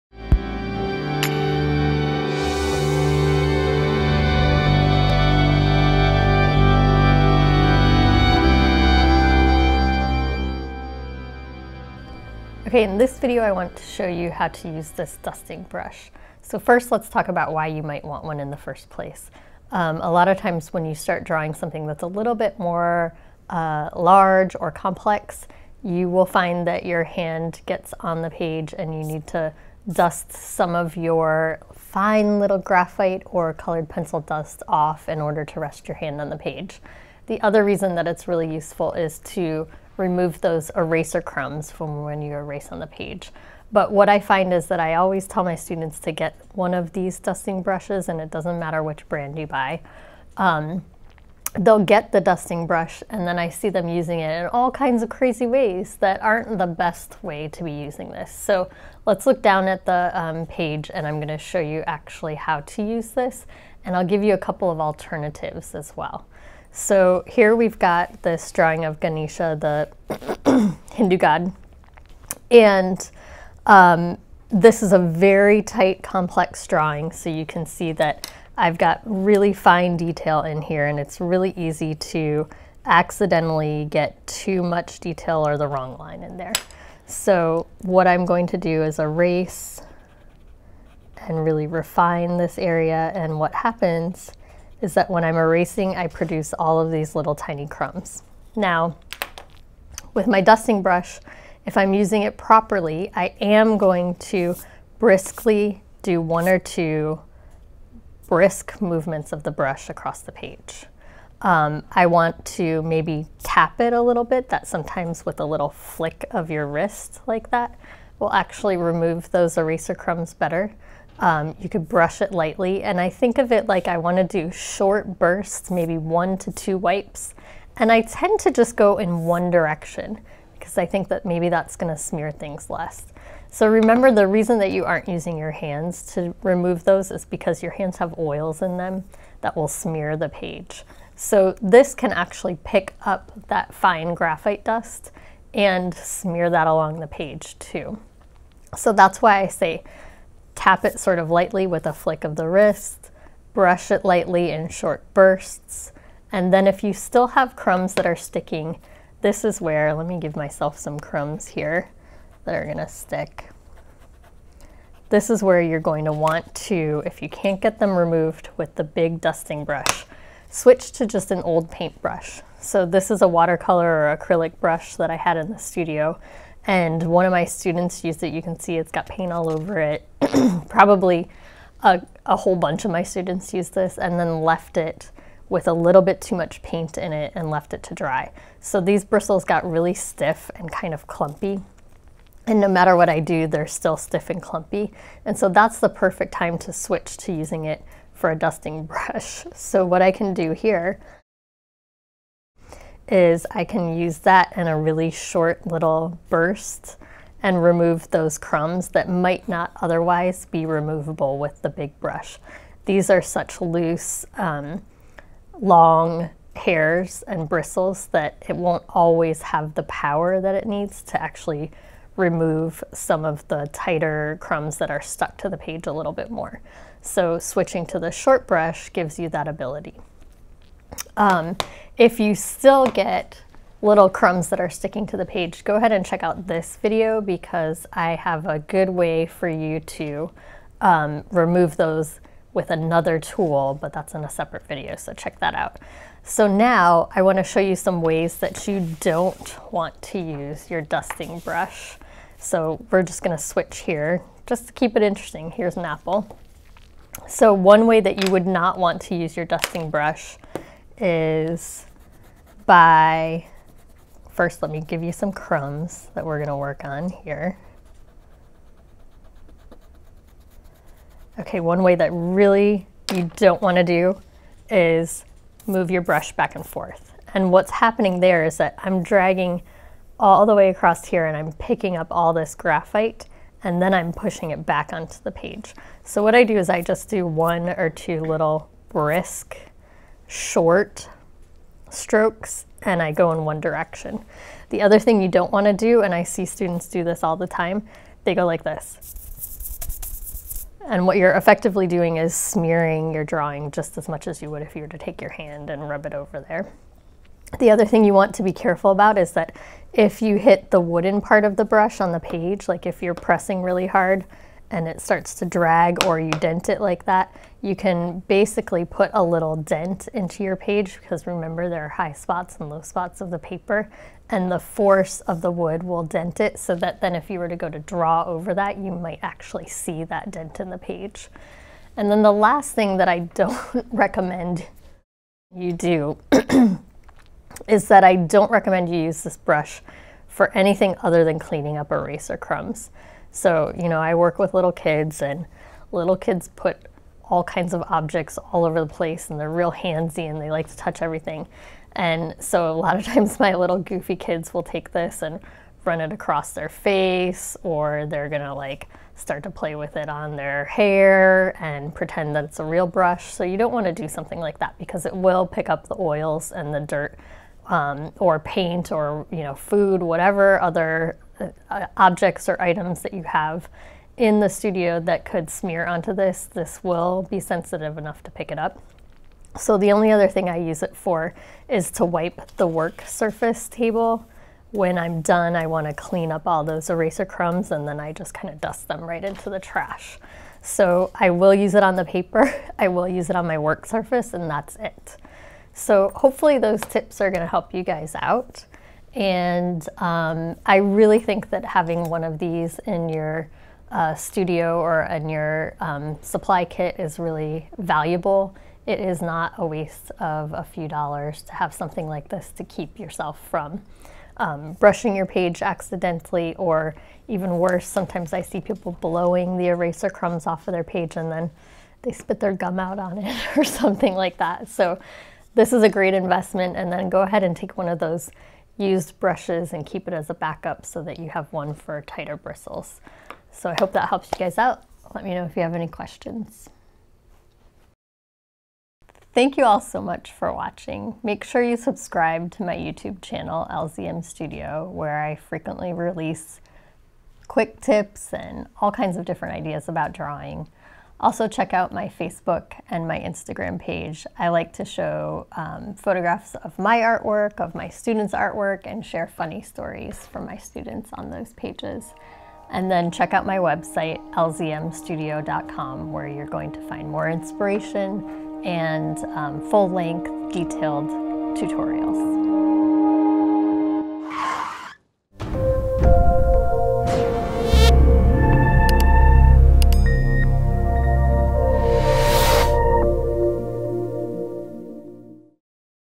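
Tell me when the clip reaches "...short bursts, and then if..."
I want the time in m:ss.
2:34.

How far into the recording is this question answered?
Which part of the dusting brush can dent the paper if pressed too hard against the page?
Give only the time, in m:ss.
5:10.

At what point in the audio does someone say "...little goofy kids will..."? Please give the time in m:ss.
5:53.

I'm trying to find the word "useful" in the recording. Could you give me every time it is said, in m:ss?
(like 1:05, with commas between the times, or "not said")
0:38.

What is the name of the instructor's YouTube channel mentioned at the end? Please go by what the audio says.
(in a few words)
LZM Studio.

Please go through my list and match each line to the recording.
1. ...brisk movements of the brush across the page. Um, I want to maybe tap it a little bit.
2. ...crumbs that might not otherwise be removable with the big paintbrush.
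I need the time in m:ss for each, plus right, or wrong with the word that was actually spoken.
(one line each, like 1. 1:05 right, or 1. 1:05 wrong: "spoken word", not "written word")
1. 1:48 right
2. 3:28 wrong: "brush", not "paintbrush".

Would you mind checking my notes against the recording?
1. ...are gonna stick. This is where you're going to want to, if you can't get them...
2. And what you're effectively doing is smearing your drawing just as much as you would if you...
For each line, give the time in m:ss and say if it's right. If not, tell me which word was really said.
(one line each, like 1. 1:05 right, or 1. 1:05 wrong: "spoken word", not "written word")
1. 2:42 right
2. 5:00 right.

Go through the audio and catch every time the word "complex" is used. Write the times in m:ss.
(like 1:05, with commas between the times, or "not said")
0:24, 1:16.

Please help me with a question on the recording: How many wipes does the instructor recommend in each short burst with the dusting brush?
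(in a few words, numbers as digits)
1 to 2.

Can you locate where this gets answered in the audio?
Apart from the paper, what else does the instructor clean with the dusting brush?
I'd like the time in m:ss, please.
6:22.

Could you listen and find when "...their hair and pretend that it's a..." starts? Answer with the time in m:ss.
6:00.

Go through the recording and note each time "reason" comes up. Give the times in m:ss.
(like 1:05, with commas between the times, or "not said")
0:37, 2:14.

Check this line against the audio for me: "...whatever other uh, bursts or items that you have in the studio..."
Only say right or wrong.
wrong.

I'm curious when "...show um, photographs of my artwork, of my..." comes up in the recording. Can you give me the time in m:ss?
7:34.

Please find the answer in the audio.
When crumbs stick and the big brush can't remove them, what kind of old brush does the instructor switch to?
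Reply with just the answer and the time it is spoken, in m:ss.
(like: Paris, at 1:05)
An old paintbrush, at 2:51.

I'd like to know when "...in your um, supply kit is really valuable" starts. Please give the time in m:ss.
6:45.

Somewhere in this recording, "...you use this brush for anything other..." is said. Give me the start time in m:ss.
5:38.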